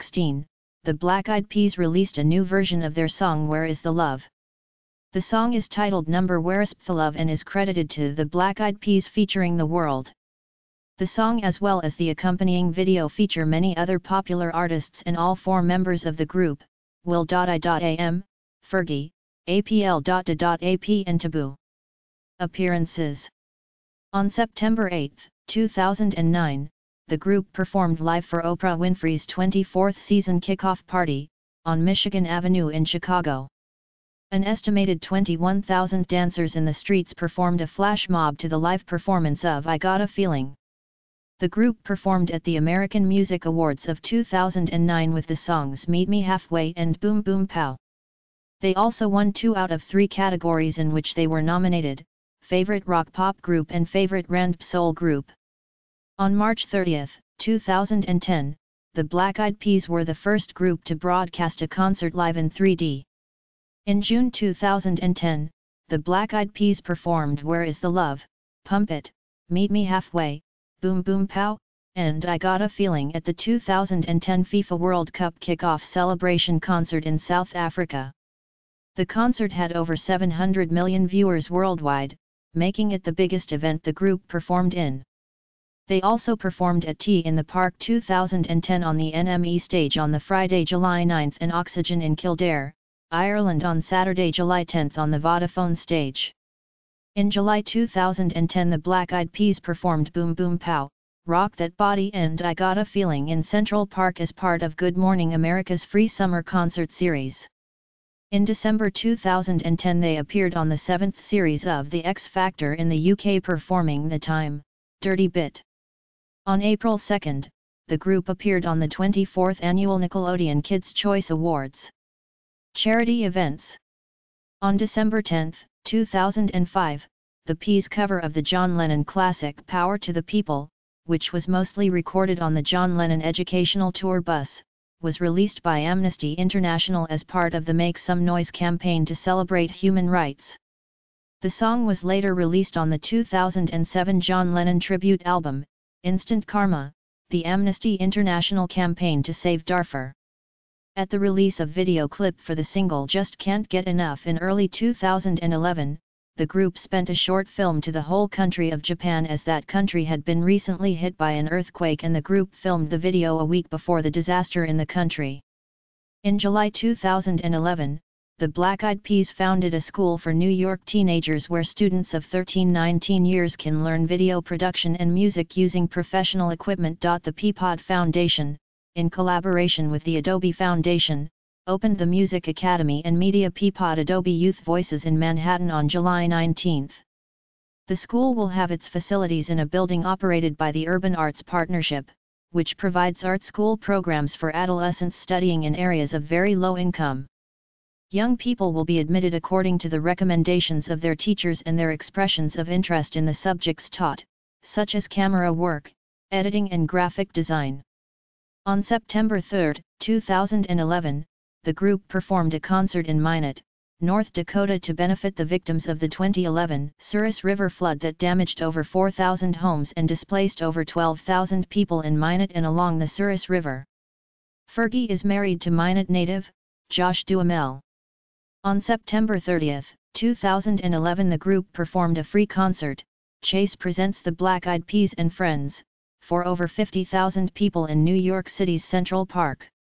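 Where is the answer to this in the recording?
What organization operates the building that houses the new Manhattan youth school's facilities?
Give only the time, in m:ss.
3:10.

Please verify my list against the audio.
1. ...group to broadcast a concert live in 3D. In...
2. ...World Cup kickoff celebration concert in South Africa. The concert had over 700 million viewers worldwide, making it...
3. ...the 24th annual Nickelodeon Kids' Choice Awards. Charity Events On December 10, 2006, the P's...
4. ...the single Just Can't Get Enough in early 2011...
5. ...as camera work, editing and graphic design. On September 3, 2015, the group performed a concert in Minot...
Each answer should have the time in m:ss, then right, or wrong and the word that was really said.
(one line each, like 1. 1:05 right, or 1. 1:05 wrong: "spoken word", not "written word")
1. 1:00 right
2. 1:14 right
3. 1:58 wrong: "2005", not "2006"
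4. 2:32 right
5. 3:24 wrong: "2011", not "2015".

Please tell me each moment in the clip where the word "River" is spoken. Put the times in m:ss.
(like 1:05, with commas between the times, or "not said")
3:37, 3:43.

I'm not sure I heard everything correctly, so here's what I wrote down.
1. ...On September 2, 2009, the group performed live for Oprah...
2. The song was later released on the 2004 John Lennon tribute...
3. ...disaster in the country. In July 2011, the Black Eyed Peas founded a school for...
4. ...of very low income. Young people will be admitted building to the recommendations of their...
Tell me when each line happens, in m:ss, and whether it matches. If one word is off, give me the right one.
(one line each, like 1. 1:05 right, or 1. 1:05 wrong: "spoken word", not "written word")
1. 0:24 wrong: "8", not "2"
2. 2:21 wrong: "2007", not "2004"
3. 2:44 right
4. 3:16 wrong: "according", not "building".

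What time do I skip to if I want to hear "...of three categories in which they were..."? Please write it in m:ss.
0:49.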